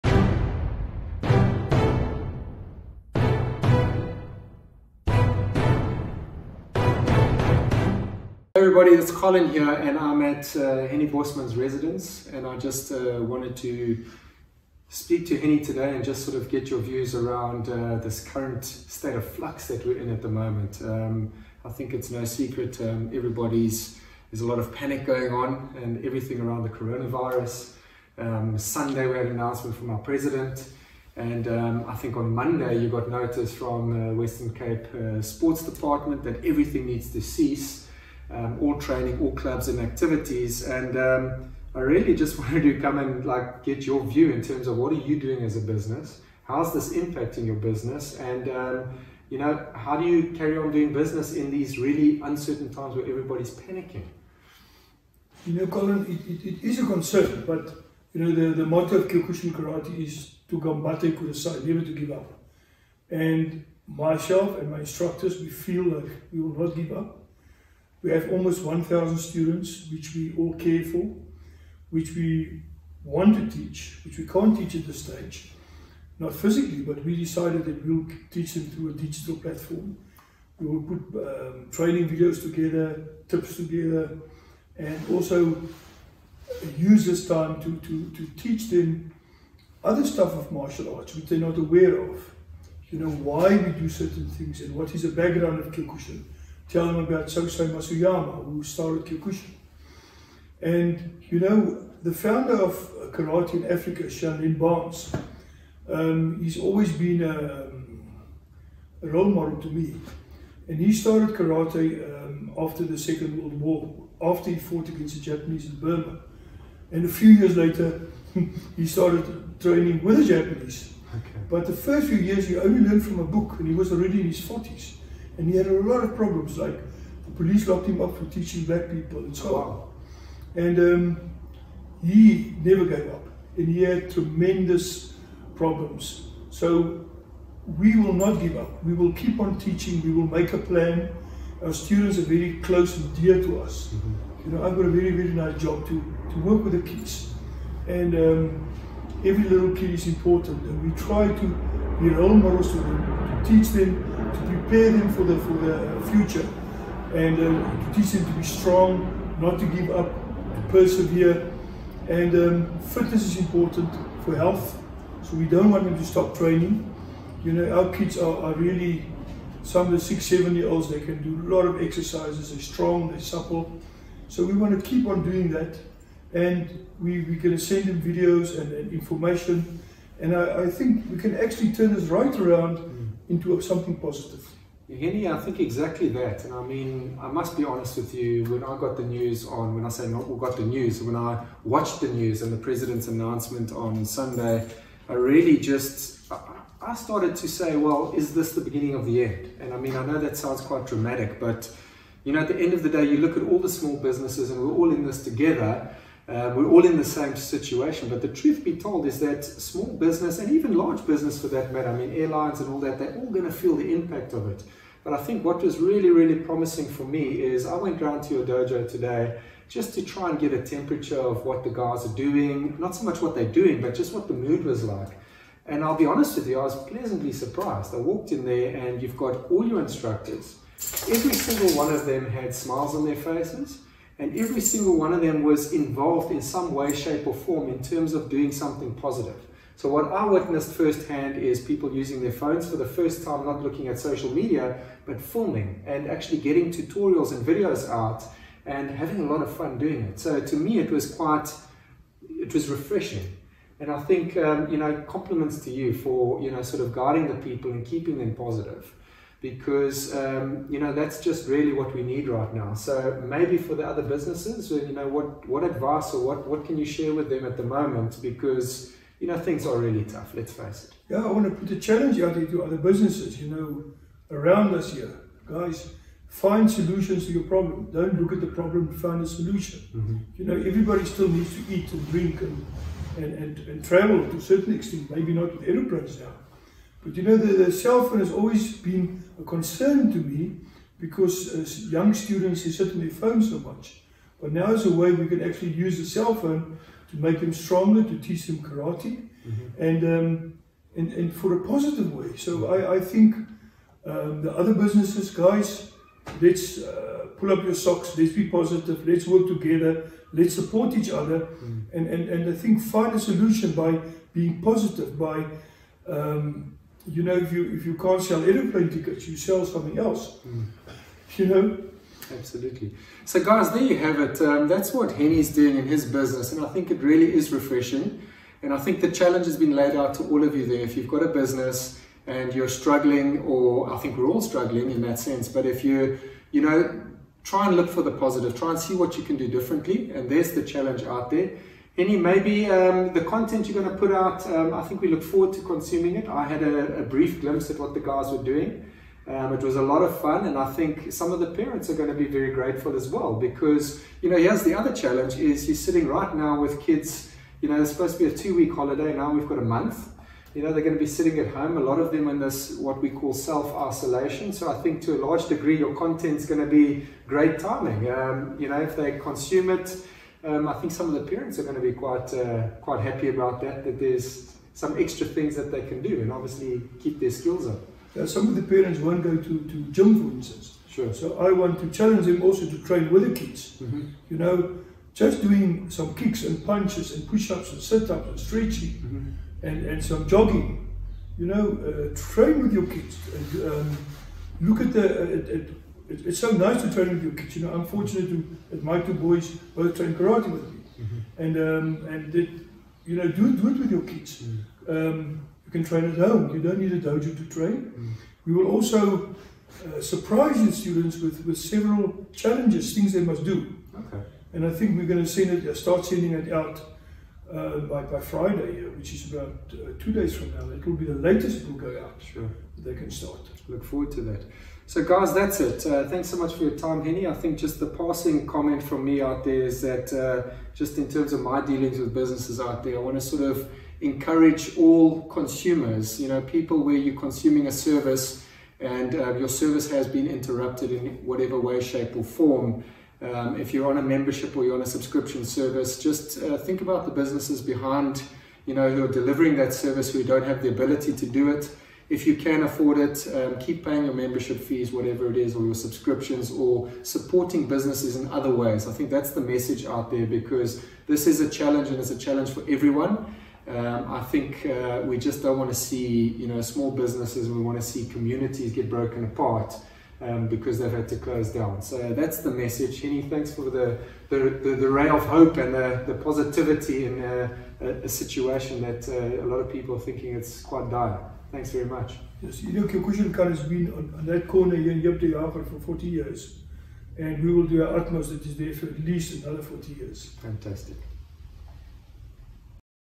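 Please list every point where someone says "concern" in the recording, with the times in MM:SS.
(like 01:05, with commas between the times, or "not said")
00:56, 04:49.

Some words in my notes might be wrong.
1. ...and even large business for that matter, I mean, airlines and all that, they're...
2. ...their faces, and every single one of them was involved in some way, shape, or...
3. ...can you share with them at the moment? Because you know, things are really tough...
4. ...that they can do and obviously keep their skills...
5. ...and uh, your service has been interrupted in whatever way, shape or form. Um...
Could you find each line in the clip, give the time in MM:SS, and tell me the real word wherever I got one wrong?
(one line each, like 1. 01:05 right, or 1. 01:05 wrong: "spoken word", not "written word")
1. 03:30 right
2. 03:53 right
3. 04:26 right
4. 06:15 right
5. 07:18 right.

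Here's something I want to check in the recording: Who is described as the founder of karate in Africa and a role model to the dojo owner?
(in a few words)
Shaolin Barnes.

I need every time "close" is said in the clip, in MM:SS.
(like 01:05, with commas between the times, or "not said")
02:22, 07:51.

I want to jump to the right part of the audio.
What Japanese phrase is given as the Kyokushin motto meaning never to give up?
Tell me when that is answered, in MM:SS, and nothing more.
01:00.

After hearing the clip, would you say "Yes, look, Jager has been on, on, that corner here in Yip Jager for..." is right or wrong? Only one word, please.
wrong.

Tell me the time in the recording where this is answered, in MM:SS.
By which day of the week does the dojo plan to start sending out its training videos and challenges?
06:58.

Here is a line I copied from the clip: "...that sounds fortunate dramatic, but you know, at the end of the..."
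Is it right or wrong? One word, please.
wrong.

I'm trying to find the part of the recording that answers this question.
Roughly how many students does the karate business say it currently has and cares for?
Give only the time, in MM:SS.
01:08.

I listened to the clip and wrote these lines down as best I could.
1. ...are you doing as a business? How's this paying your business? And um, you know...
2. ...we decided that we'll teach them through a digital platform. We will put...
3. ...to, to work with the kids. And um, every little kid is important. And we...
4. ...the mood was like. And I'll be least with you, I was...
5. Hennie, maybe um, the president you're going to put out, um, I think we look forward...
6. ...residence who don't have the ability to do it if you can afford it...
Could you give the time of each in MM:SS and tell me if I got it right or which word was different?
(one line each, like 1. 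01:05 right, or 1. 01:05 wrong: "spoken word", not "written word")
1. 00:44 wrong: "impacting", not "paying"
2. 01:17 right
3. 02:25 right
4. 03:44 wrong: "honest", not "least"
5. 05:41 wrong: "content", not "president"
6. 07:29 wrong: "service", not "residence".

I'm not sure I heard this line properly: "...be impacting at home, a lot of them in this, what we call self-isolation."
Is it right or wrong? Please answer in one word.
wrong.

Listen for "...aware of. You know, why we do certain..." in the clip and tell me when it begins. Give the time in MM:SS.
01:31.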